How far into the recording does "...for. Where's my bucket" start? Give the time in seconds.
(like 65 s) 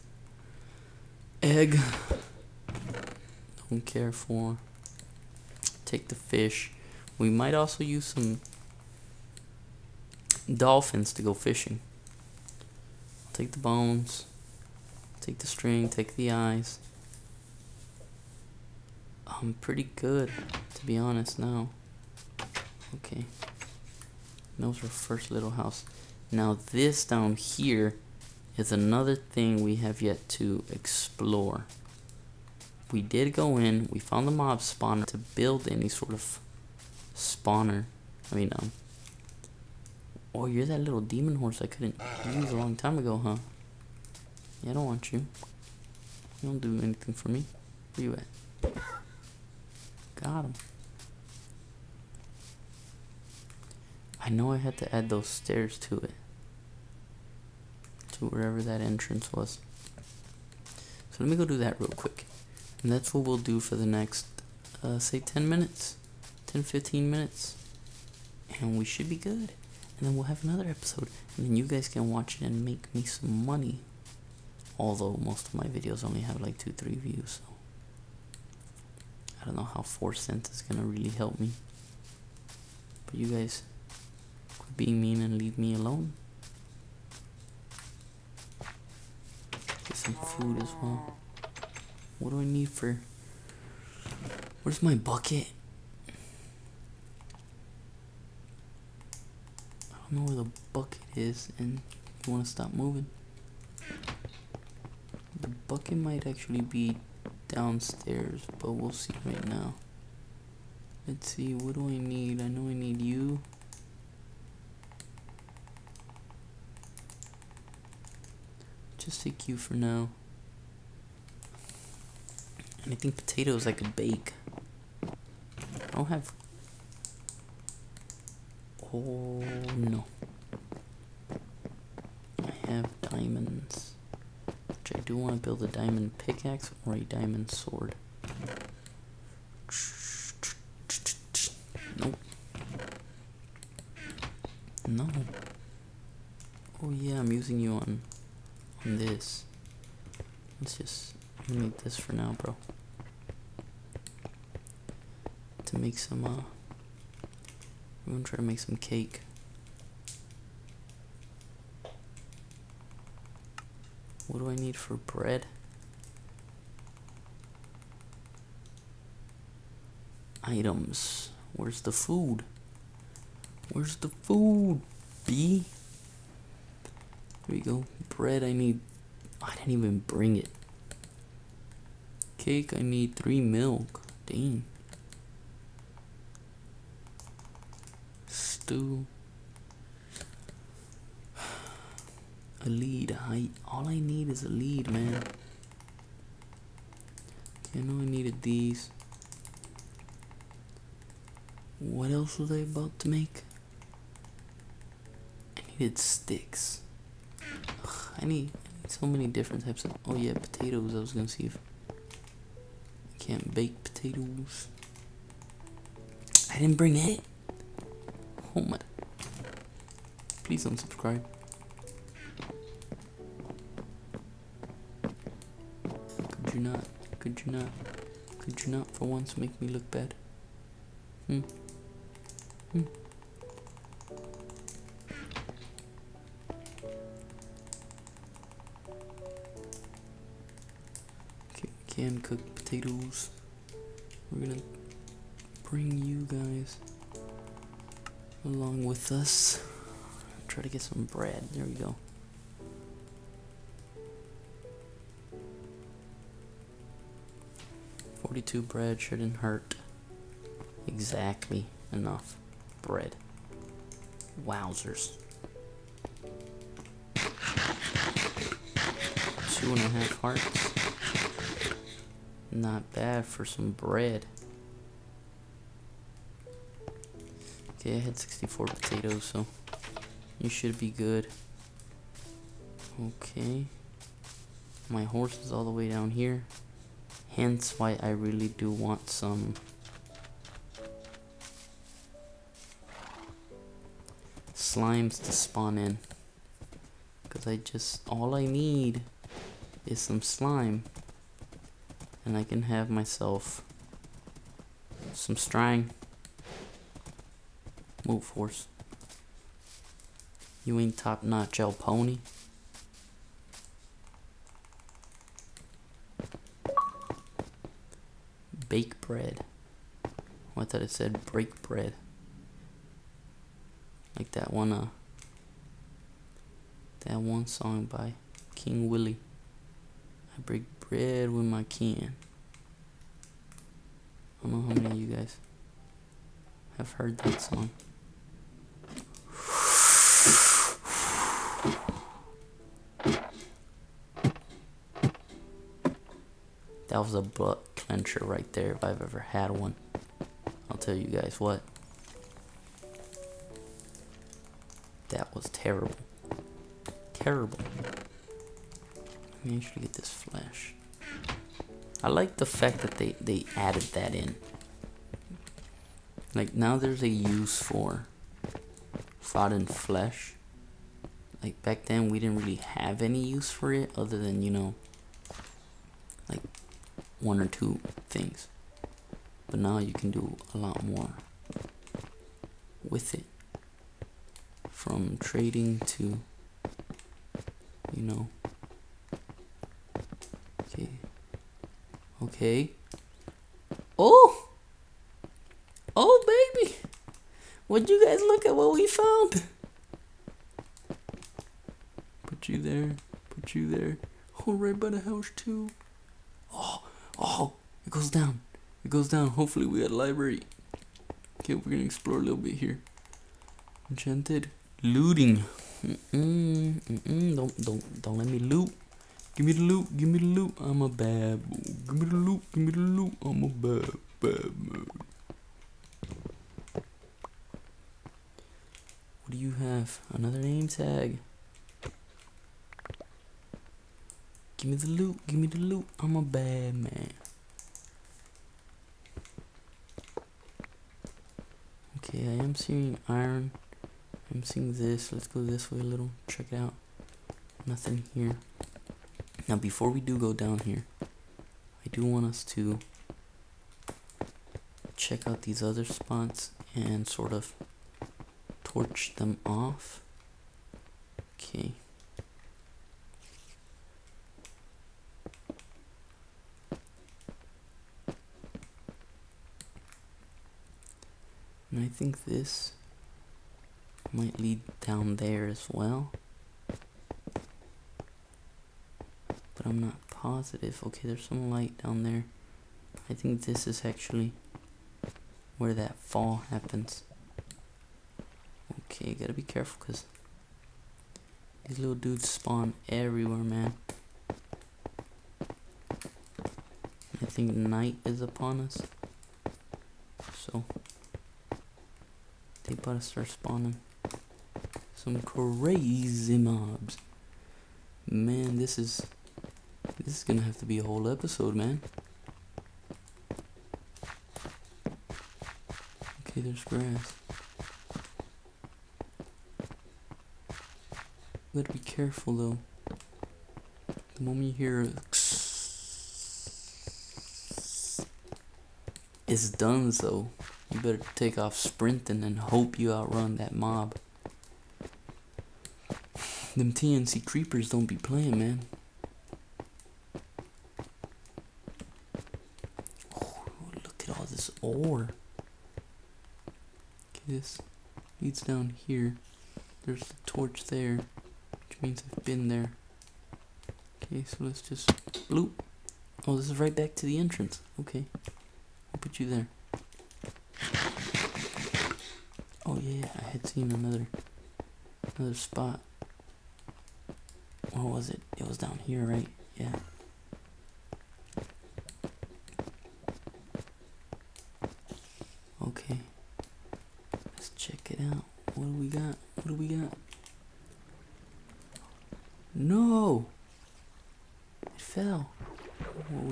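92 s.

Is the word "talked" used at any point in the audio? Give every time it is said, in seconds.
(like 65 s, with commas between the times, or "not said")
not said.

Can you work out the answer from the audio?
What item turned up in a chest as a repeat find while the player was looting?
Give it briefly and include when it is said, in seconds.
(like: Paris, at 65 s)
name tag, at 430 s.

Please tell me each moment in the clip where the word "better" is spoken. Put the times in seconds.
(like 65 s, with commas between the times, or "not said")
502 s, 530 s.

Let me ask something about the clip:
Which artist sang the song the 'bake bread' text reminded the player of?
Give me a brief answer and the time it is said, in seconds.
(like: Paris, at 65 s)
King Willie, at 328 s.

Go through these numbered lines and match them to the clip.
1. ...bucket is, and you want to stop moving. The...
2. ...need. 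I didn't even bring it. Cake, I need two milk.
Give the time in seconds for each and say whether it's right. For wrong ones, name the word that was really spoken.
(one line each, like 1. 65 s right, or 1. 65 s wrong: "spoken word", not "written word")
1. 100 s right
2. 178 s wrong: "three", not "two".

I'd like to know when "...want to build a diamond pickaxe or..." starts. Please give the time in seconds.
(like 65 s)
135 s.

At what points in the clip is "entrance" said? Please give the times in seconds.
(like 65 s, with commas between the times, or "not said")
58 s, 557 s.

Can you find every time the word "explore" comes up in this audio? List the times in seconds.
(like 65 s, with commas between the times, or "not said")
30 s, 411 s.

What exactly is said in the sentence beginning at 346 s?
That was a butt clencher right there if I've ever had one.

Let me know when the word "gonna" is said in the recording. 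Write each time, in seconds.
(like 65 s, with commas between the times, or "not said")
158 s, 211 s, 244 s, 411 s, 510 s.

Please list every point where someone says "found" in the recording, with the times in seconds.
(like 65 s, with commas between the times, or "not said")
33 s, 398 s.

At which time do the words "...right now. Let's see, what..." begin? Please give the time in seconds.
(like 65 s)
109 s.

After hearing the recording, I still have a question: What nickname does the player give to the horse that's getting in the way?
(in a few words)
El Pony.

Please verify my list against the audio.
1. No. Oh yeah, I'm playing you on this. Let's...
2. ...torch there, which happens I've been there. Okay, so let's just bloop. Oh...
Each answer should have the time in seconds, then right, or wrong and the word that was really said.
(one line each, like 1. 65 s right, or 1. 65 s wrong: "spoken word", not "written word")
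1. 144 s wrong: "using", not "playing"
2. 550 s wrong: "means", not "happens".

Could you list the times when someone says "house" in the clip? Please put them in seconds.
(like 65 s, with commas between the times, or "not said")
25 s, 405 s.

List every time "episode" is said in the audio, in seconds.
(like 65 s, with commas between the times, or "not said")
70 s, 511 s.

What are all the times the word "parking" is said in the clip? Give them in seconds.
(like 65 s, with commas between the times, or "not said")
not said.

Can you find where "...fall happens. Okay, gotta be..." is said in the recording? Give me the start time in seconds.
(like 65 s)
485 s.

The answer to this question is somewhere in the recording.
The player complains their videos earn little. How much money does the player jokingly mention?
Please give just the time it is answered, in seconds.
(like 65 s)
79 s.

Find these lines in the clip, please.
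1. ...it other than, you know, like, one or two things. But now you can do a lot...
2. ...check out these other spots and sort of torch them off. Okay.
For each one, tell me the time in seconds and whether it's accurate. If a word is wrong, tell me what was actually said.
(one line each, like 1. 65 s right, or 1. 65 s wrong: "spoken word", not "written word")
1. 373 s right
2. 454 s right.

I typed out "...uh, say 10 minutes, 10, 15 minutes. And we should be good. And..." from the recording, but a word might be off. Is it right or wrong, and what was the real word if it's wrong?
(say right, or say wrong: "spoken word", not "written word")
right.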